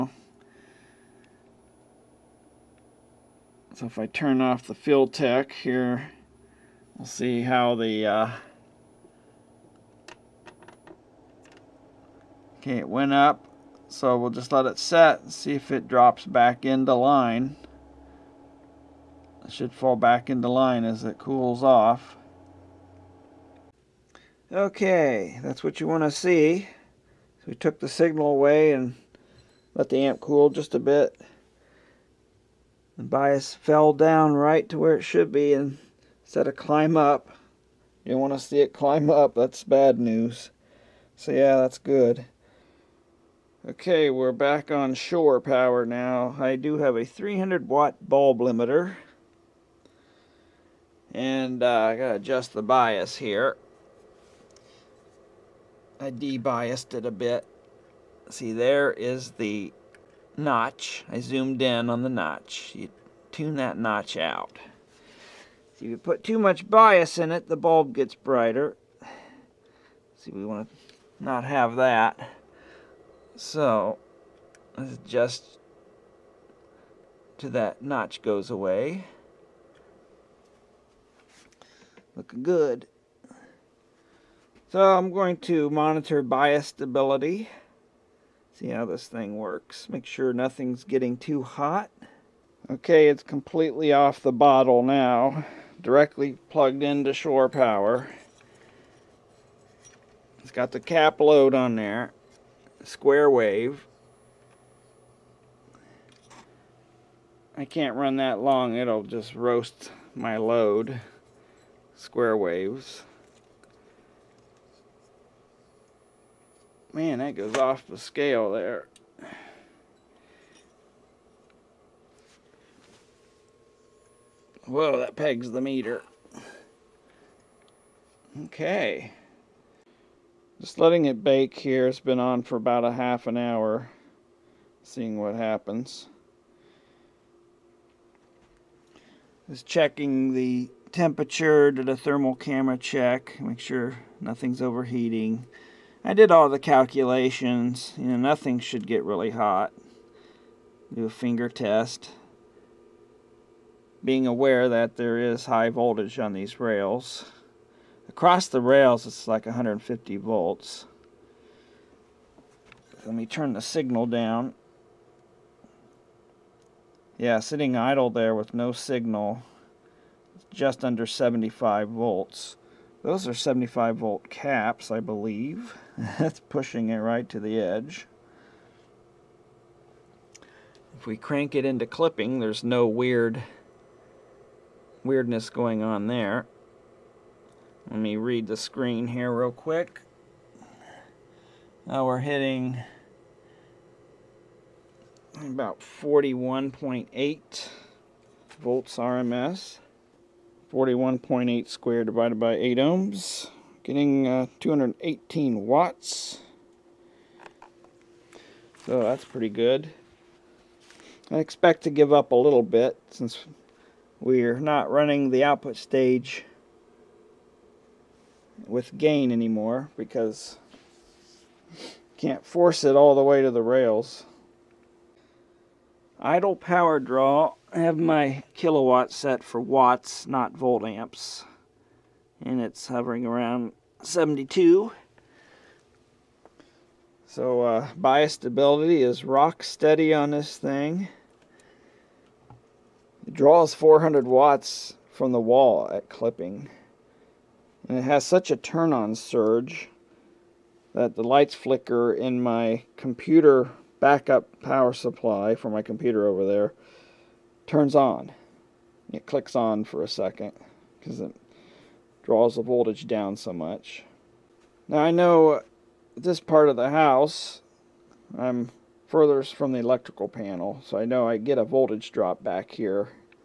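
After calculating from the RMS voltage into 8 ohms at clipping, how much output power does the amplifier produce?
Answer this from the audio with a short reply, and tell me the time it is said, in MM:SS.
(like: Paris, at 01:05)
218 watts, at 03:24.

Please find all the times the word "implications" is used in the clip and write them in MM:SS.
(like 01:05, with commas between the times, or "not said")
not said.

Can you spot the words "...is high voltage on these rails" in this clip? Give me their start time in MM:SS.
02:35.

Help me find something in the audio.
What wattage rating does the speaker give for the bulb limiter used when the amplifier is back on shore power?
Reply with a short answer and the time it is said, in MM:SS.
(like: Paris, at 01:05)
300 watt, at 00:47.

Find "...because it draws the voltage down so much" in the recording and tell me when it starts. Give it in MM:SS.
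04:20.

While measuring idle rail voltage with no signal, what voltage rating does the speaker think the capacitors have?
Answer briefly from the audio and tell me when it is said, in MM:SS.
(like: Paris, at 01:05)
75 volt, at 02:53.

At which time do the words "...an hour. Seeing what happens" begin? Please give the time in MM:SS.
02:13.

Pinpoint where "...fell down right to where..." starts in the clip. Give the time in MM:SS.
00:33.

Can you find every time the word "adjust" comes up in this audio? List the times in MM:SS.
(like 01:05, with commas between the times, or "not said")
00:52, 01:14.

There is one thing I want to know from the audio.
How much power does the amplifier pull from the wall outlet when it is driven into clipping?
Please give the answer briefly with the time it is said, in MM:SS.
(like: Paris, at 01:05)
400 watts, at 04:03.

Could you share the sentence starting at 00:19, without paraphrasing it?
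It should fall back into line as it cools off.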